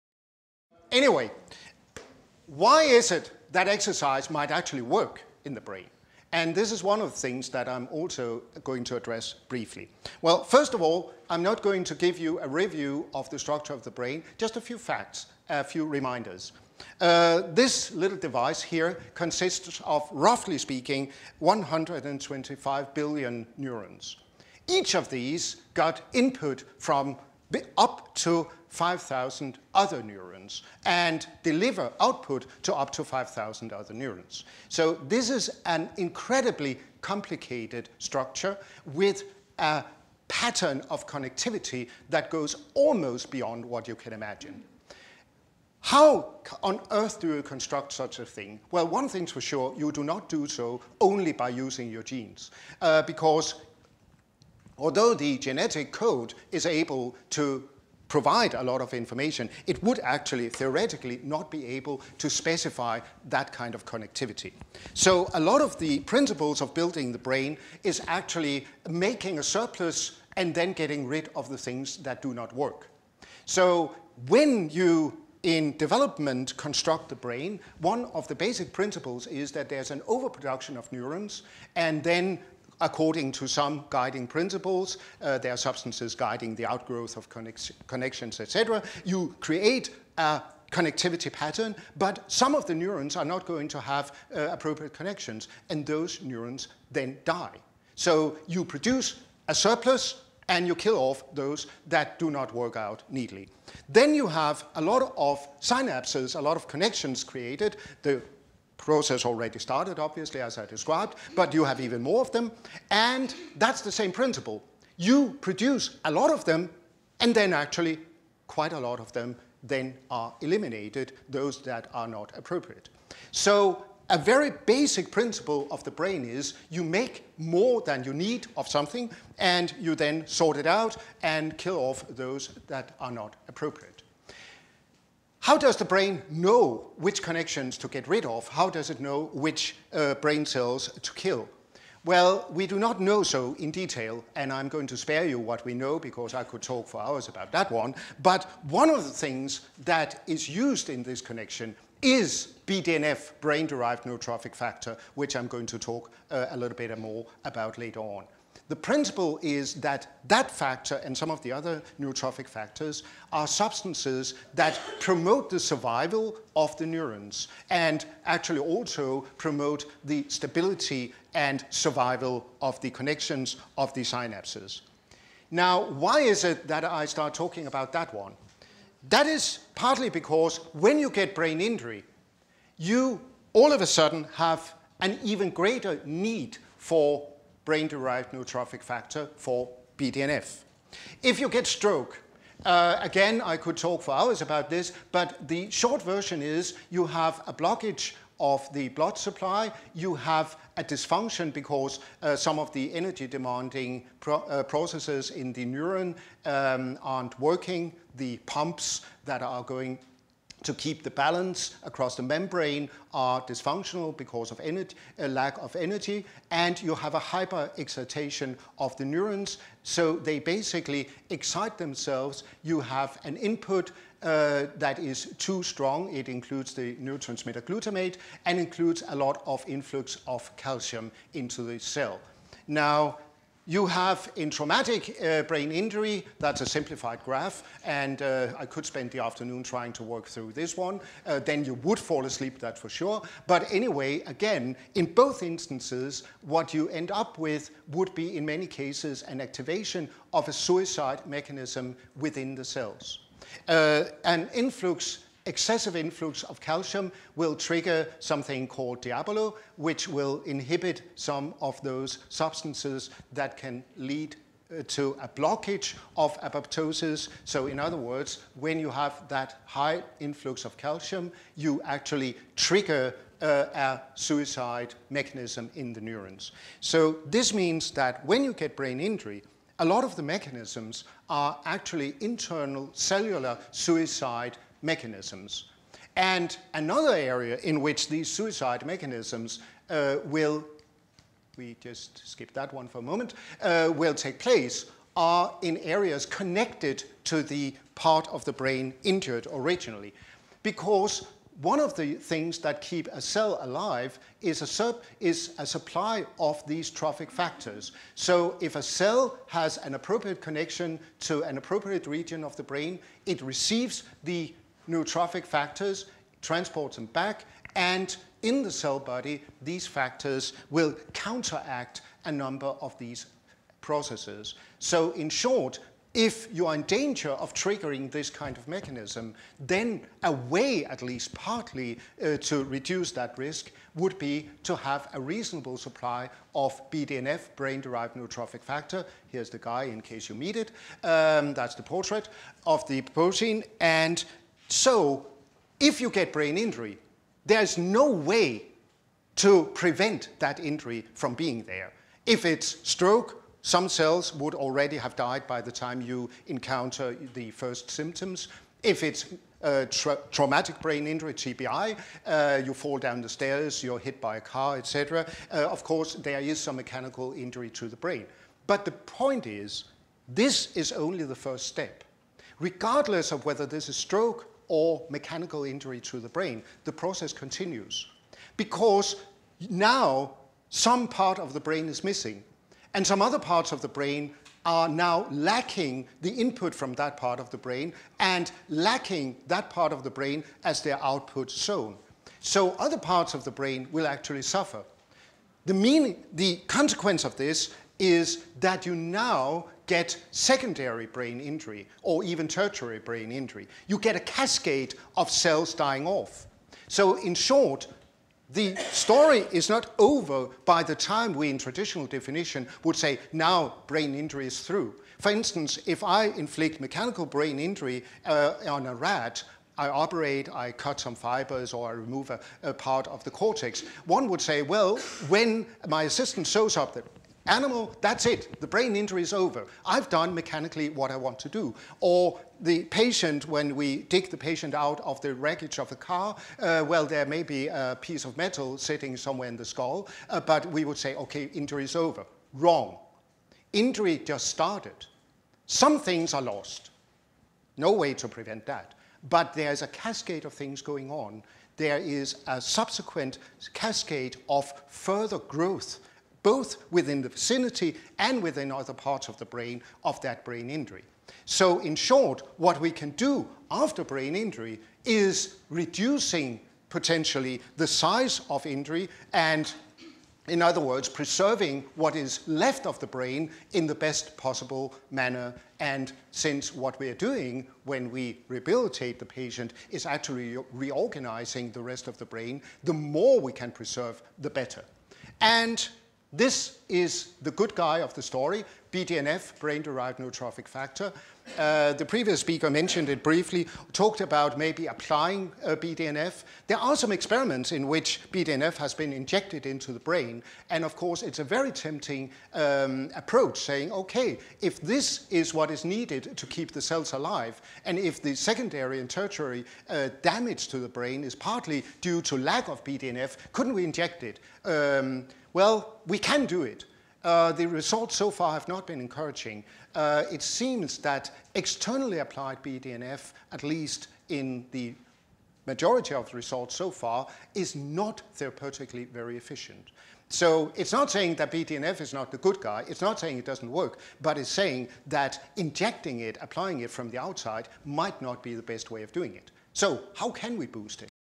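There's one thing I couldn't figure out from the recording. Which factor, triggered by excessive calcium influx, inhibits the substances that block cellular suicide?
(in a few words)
DIABLO.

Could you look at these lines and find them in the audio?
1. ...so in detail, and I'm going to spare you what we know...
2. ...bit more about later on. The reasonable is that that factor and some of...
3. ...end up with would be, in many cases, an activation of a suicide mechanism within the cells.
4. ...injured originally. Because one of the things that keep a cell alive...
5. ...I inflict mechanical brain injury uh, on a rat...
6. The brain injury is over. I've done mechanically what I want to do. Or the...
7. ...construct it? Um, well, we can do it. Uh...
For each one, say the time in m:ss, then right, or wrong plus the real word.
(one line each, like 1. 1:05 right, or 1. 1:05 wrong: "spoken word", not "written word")
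1. 2:23 right
2. 2:36 wrong: "principle", not "reasonable"
3. 4:06 right
4. 4:59 right
5. 6:56 right
6. 7:08 right
7. 8:33 wrong: "inject", not "construct".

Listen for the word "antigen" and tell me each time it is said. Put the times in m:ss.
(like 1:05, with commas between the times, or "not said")
not said.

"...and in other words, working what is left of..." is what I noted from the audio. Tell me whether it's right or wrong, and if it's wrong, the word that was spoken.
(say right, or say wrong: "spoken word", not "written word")
wrong: "preserving", not "working".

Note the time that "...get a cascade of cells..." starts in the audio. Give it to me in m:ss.
6:43.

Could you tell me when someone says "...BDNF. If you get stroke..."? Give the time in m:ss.
3:09.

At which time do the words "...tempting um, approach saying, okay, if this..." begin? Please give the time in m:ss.
8:21.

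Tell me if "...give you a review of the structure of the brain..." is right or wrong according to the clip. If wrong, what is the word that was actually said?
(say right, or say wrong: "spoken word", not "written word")
right.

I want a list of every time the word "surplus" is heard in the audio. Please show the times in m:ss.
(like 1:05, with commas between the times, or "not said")
1:09, 1:39.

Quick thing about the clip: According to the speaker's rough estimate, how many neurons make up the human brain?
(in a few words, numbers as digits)
125 billion.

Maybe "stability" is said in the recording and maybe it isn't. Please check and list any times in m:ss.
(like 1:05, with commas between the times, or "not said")
2:50.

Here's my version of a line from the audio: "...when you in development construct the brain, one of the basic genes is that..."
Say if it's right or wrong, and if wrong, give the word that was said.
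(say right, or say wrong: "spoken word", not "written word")
wrong: "principles", not "genes".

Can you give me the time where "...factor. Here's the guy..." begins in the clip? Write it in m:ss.
5:38.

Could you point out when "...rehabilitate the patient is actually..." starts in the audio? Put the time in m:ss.
7:58.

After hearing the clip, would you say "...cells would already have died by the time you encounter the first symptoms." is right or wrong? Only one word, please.
right.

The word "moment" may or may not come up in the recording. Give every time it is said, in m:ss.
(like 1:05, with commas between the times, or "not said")
4:53.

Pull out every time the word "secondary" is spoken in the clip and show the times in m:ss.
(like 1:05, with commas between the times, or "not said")
6:40, 8:28.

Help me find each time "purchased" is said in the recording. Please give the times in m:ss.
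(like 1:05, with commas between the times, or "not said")
not said.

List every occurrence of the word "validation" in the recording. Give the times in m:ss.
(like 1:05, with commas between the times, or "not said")
not said.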